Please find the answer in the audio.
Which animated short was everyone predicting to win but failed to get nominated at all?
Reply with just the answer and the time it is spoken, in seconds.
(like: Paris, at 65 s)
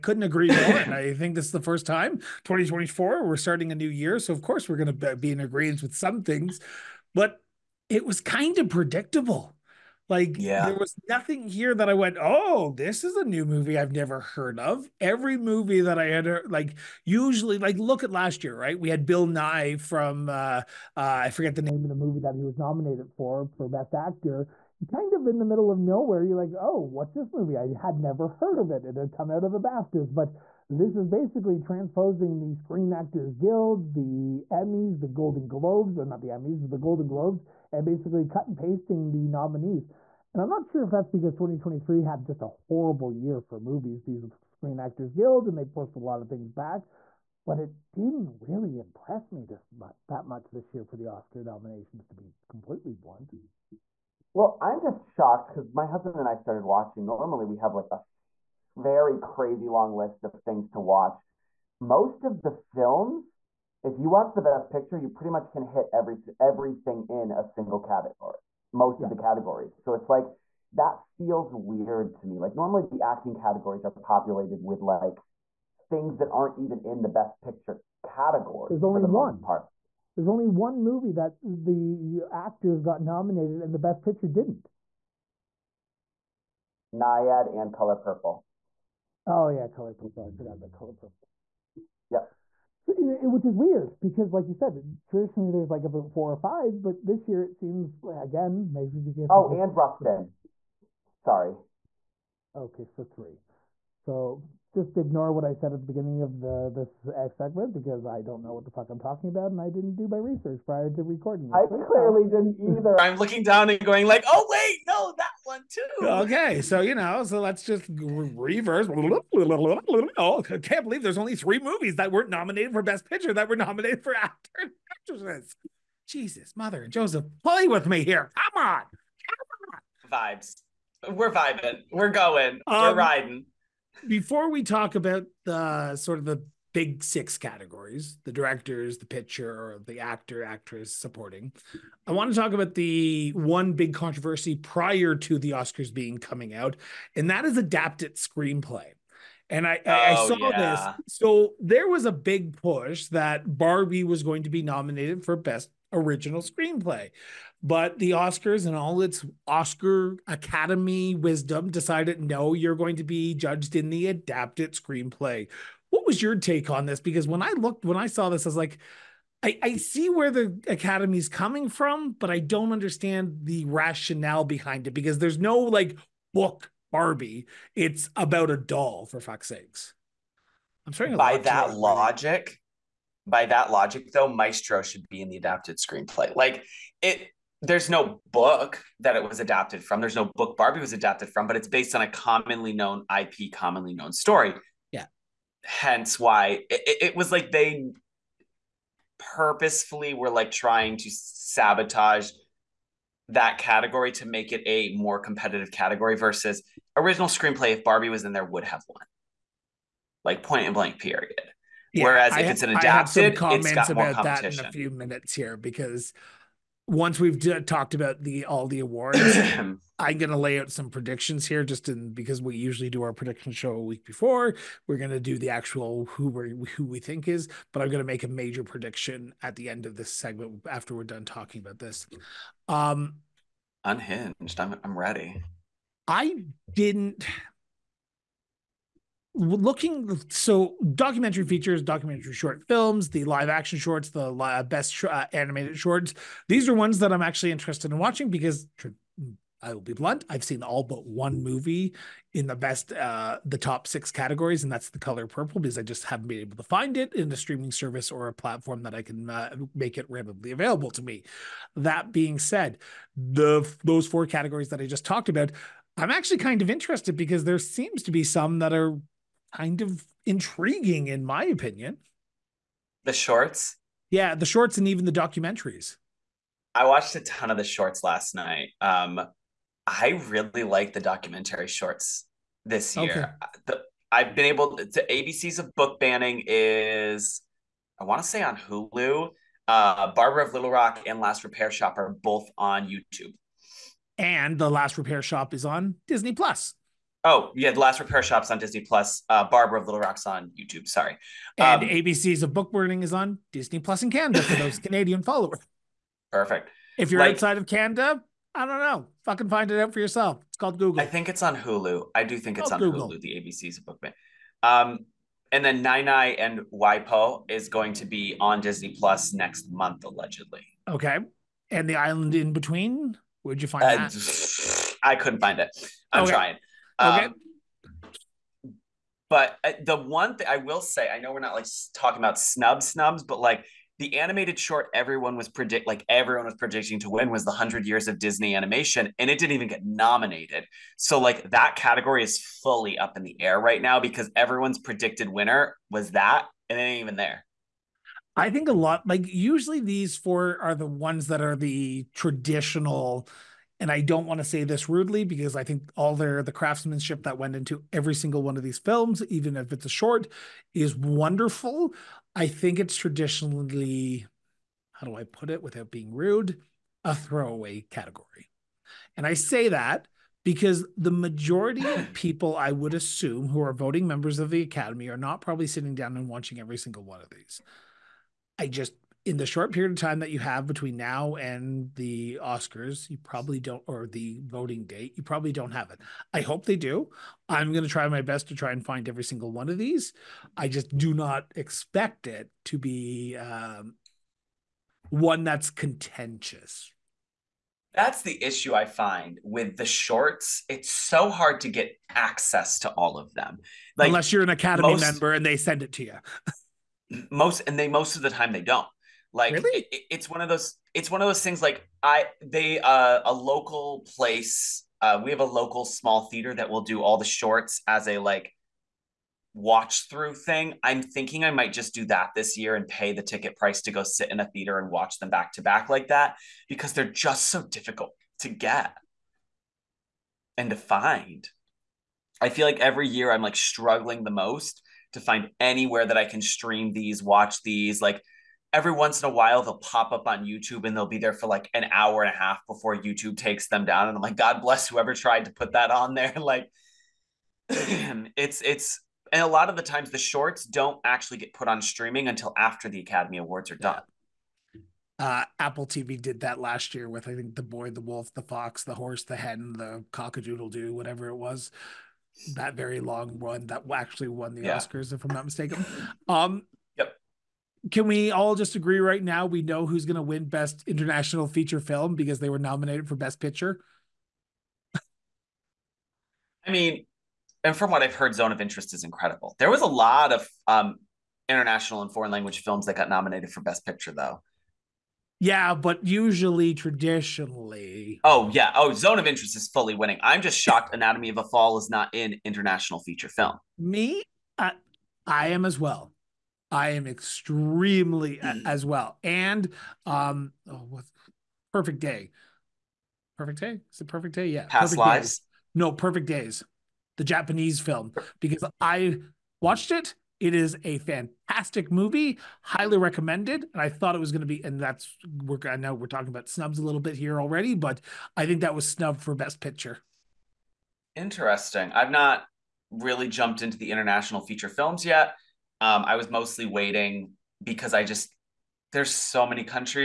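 100 Years of Disney Animation, at 337 s.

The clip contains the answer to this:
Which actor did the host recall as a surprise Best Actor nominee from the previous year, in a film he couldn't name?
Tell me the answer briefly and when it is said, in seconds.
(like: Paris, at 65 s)
Bill Nighy, at 19 s.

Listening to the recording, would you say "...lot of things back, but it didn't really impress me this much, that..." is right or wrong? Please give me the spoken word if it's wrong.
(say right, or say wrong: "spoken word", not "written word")
right.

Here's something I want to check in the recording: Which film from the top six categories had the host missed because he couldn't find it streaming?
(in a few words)
The Color Purple.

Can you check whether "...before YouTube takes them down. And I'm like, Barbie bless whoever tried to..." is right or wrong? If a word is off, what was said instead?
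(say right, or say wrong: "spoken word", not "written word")
wrong: "God", not "Barbie".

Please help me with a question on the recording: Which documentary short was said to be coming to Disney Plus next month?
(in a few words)
Nai Nai and Waipo.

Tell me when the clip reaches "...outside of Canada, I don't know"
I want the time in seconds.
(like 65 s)
307 s.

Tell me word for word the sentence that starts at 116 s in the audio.
Okay, so you know, so let's just reverse.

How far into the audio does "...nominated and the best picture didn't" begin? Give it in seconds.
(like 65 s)
83 s.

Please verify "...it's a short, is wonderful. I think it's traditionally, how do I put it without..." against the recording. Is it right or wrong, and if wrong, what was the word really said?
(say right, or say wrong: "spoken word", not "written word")
right.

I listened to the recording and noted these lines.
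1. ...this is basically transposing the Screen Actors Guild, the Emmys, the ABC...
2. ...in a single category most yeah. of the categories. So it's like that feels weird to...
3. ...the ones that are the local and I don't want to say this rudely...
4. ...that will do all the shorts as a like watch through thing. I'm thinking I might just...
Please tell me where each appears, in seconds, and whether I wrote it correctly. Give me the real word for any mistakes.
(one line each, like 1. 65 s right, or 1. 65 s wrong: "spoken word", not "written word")
1. 30 s wrong: "Golden", not "ABC"
2. 67 s right
3. 350 s wrong: "traditional", not "local"
4. 416 s right.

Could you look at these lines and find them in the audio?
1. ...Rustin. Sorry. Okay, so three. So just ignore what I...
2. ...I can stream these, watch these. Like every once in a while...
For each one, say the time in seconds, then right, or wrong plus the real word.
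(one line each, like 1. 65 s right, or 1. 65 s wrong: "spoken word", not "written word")
1. 99 s right
2. 436 s right.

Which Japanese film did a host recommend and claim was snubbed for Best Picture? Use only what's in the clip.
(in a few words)
Perfect Days.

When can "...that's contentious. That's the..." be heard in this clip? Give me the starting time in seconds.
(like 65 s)
395 s.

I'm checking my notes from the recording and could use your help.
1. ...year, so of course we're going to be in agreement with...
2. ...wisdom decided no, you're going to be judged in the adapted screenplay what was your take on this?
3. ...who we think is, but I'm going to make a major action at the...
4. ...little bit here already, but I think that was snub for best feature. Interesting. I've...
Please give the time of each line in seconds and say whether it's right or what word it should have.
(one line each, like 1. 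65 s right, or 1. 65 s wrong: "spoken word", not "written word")
1. 3 s right
2. 161 s right
3. 226 s wrong: "prediction", not "action"
4. 516 s wrong: "picture", not "feature".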